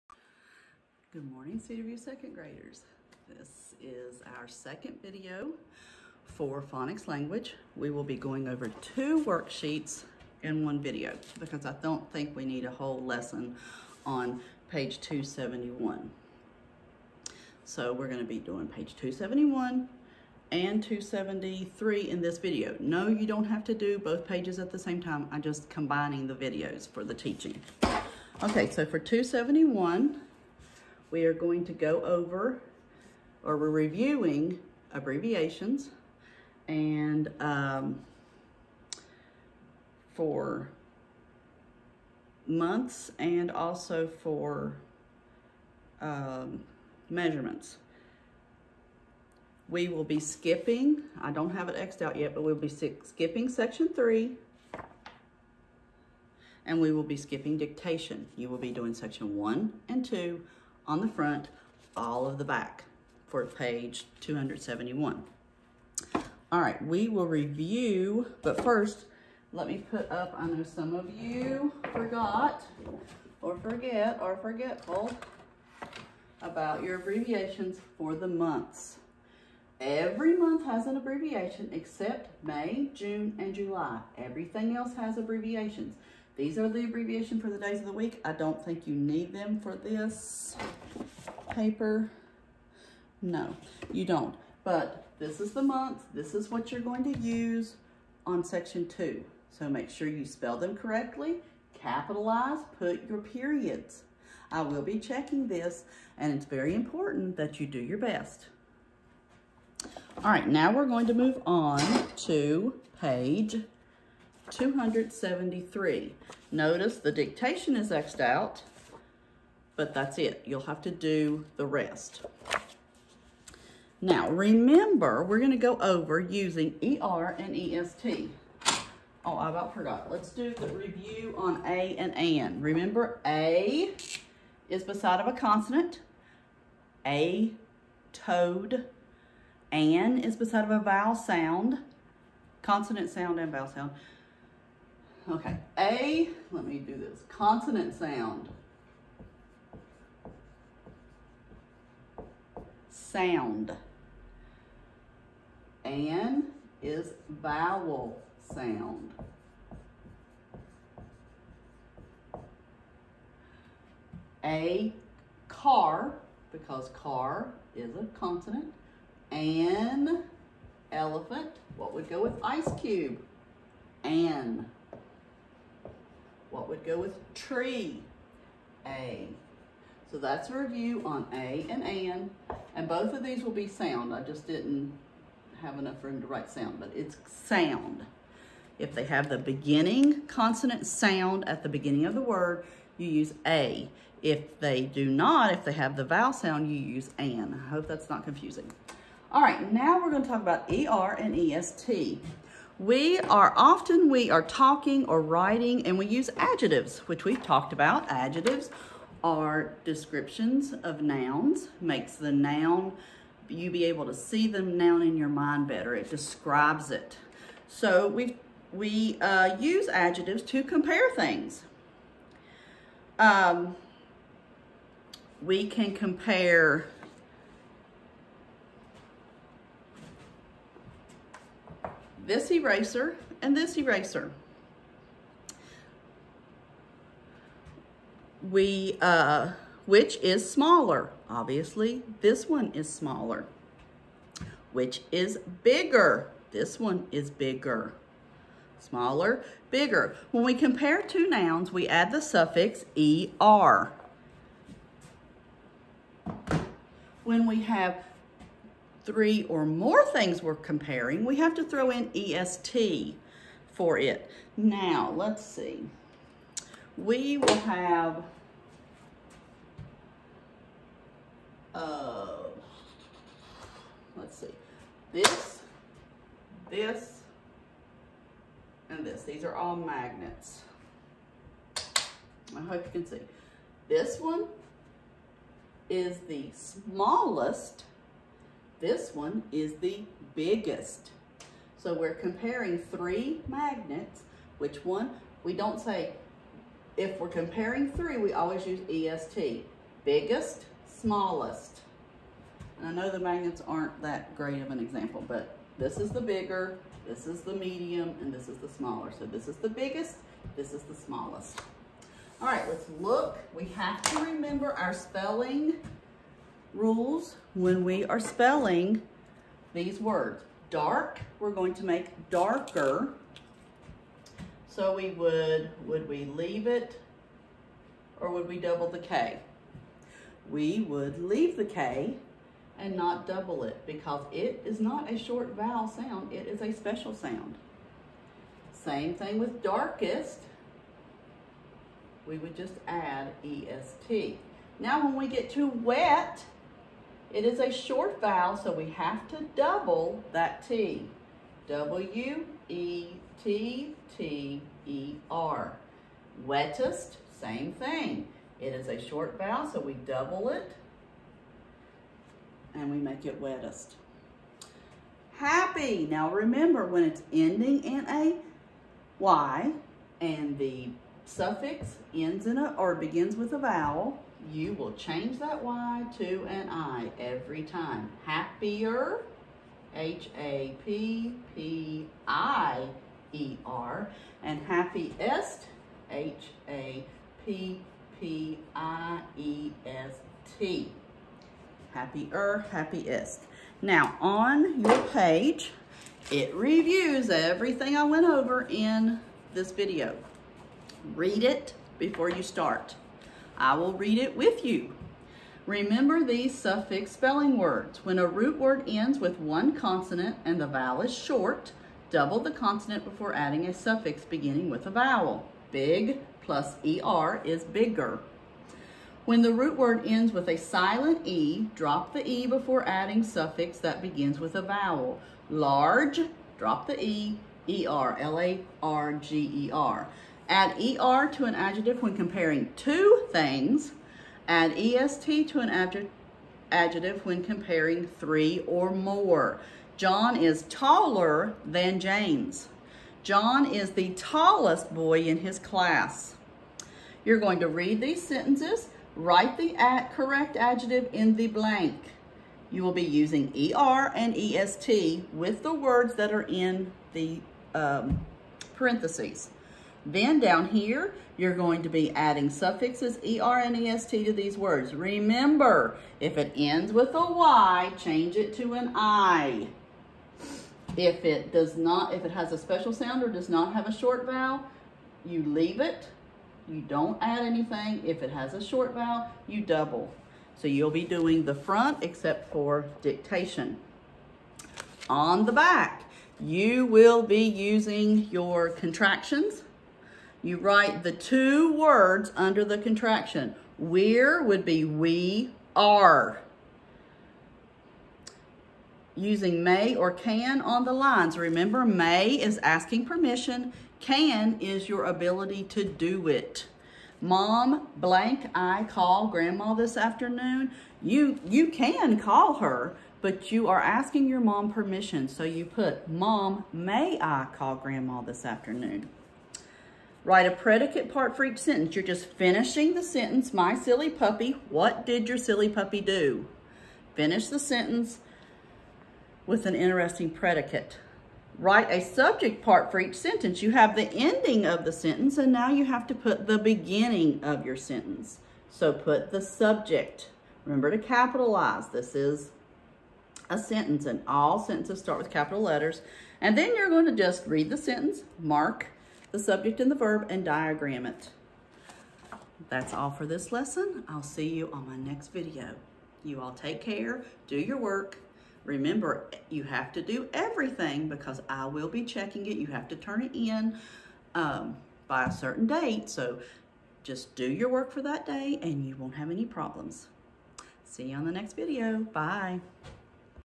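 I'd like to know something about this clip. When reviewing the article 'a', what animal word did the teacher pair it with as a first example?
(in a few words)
Toad.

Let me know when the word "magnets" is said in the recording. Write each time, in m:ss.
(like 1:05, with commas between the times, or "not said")
4:39, 4:53, 5:03.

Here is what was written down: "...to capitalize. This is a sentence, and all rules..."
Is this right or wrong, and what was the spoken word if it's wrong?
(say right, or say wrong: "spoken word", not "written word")
wrong: "sentences", not "rules".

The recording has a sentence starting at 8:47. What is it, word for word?
Finish the sentence with an interesting predicate.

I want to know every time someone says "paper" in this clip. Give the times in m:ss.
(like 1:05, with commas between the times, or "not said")
1:31.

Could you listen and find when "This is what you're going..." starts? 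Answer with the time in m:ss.
1:36.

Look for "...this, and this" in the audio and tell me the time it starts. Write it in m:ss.
4:36.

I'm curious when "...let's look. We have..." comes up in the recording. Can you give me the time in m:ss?
5:12.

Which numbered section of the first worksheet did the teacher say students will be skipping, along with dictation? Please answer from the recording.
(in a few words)
Section three.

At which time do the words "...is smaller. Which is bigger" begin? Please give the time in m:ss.
4:02.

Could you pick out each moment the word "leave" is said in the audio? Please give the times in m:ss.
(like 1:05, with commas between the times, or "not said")
5:26, 5:31, 7:55.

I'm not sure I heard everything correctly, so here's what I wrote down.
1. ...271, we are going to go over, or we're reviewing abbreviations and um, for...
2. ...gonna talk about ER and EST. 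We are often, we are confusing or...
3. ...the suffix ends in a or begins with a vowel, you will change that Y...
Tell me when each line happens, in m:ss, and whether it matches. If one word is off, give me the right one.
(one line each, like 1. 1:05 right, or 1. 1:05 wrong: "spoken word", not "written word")
1. 0:28 right
2. 3:20 wrong: "talking", not "confusing"
3. 6:10 right.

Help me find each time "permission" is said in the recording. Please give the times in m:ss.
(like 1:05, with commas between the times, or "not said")
8:23, 8:34.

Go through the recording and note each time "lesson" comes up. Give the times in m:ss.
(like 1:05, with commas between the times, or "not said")
0:13, 9:13.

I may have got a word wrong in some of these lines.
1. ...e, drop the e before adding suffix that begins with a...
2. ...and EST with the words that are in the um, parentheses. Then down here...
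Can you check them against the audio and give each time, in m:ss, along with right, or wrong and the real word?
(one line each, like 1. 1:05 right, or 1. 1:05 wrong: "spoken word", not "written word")
1. 7:01 right
2. 7:34 right.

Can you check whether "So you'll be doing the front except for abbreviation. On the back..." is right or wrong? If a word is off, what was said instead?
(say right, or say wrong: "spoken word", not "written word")
wrong: "dictation", not "abbreviation".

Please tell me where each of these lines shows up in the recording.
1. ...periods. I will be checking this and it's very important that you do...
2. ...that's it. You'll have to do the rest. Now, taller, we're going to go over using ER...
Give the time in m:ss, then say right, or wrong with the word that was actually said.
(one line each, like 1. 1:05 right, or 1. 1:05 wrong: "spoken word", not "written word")
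1. 1:43 right
2. 1:59 wrong: "remember", not "taller".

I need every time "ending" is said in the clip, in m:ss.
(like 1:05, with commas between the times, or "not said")
6:07, 8:54.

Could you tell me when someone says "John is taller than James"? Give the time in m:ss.
7:19.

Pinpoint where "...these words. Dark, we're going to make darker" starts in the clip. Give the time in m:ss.
5:19.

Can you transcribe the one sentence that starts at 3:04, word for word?
I just didn't have enough room to write sound, but it's sound.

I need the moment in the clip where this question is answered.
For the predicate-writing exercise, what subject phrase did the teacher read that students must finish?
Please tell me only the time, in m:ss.
8:43.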